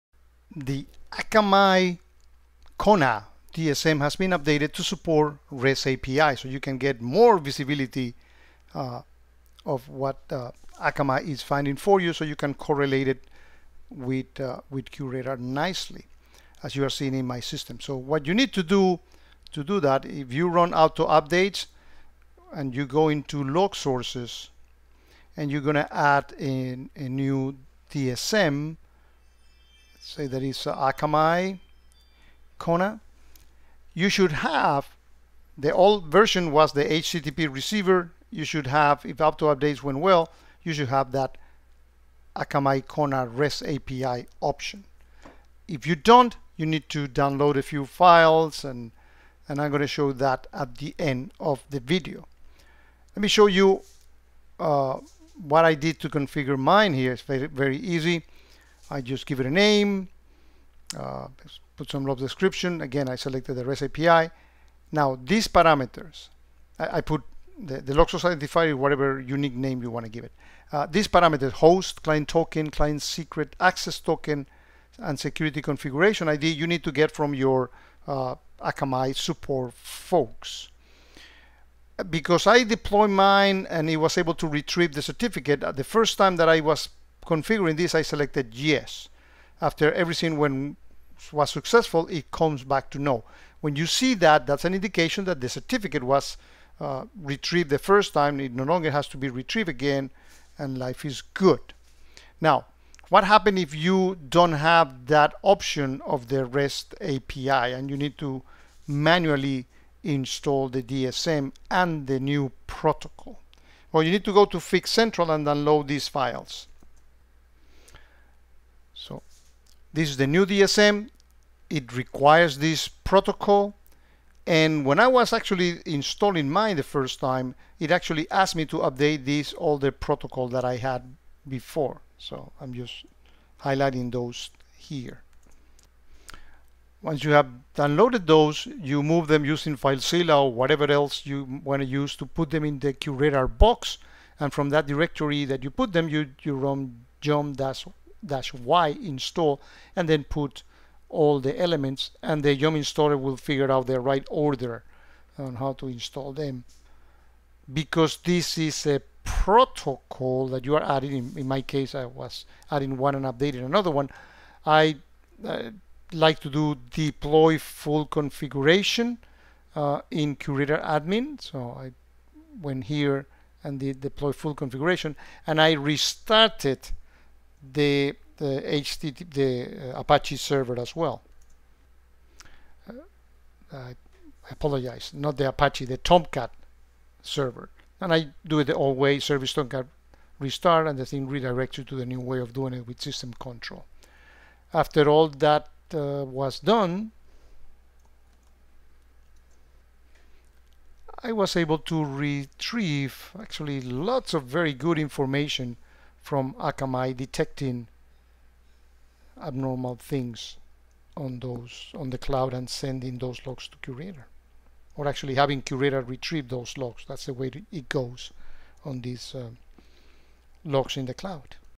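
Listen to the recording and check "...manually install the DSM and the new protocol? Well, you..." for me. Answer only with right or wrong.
right.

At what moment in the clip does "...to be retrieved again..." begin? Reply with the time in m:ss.
1:39.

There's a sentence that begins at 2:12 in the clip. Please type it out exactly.
So I'm just highlighting those here.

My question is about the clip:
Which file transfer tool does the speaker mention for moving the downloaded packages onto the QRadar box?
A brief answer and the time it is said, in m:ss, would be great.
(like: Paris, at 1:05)
FileZilla, at 2:19.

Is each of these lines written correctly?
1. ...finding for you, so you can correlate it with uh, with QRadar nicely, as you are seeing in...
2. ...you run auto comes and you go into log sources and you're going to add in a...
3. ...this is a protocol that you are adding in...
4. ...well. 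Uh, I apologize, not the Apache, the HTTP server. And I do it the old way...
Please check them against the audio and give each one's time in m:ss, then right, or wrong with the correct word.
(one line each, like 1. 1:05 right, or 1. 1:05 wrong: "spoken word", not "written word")
1. 0:11 right
2. 0:20 wrong: "updates", not "comes"
3. 2:38 right
4. 3:00 wrong: "Tomcat", not "HTTP".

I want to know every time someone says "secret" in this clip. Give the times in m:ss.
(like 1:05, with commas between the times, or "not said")
1:13.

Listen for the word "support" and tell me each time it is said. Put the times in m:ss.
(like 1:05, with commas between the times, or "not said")
0:04, 1:19.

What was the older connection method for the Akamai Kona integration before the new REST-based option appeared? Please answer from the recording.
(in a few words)
HTTP receiver.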